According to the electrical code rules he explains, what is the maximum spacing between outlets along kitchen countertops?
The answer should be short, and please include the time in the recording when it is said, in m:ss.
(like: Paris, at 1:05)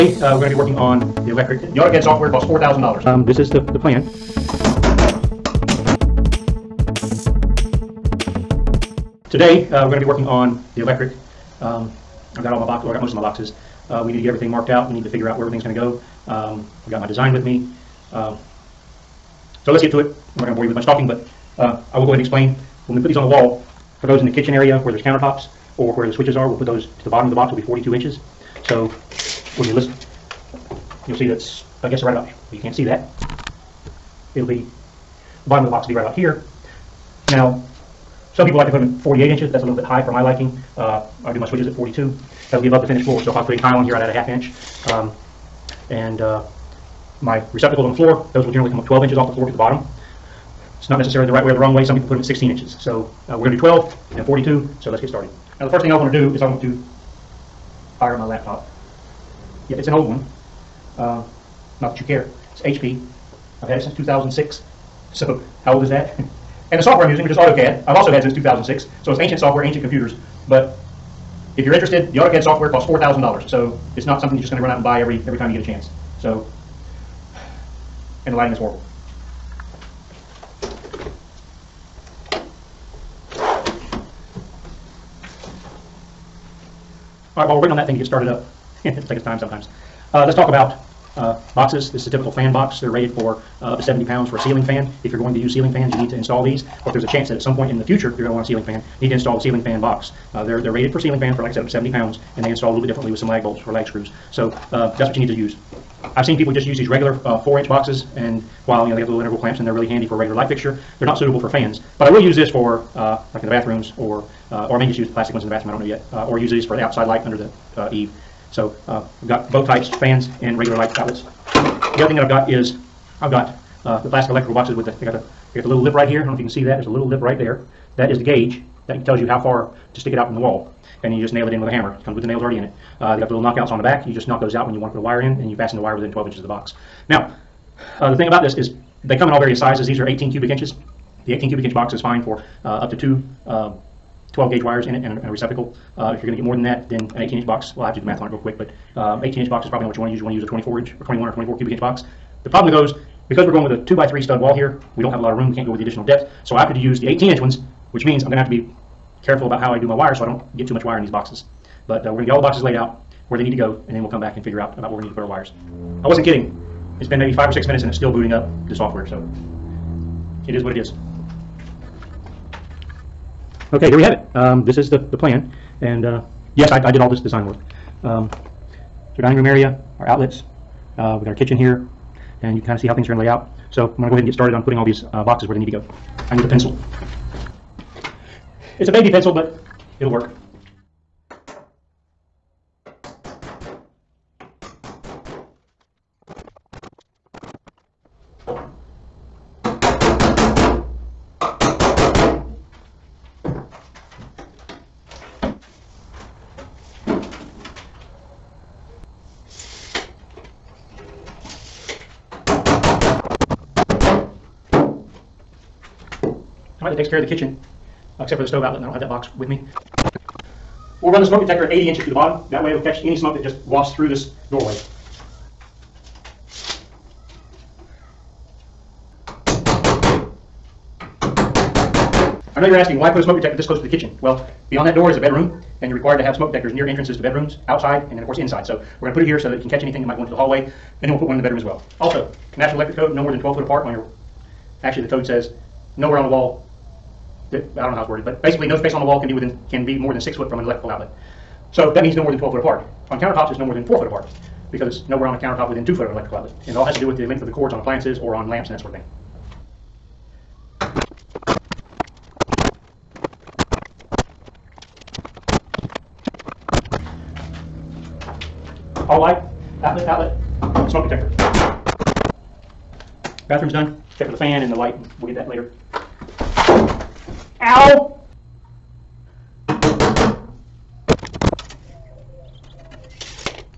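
4 foot, at 4:13.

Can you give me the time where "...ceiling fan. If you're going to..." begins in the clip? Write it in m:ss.
1:34.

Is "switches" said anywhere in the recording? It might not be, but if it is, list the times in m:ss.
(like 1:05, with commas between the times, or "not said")
0:26, 0:41.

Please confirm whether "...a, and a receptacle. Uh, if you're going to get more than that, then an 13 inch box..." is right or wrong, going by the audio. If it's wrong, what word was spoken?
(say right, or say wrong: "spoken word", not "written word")
wrong: "18", not "13".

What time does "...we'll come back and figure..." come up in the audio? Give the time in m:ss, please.
2:44.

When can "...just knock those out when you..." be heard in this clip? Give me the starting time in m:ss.
2:14.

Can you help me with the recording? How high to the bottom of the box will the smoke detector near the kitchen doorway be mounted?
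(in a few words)
80 inches.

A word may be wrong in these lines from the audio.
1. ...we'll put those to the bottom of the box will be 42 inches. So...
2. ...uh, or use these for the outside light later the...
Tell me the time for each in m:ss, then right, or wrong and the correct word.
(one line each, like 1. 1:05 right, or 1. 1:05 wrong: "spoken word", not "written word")
1. 0:26 right
2. 1:56 wrong: "under", not "later".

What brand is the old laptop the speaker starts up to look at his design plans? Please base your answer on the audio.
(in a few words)
HP.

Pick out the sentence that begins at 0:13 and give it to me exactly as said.
Uh, we need to get everything marked out.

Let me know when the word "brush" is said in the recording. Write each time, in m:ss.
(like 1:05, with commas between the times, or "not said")
not said.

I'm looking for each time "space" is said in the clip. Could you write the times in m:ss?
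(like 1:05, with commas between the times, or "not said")
4:08.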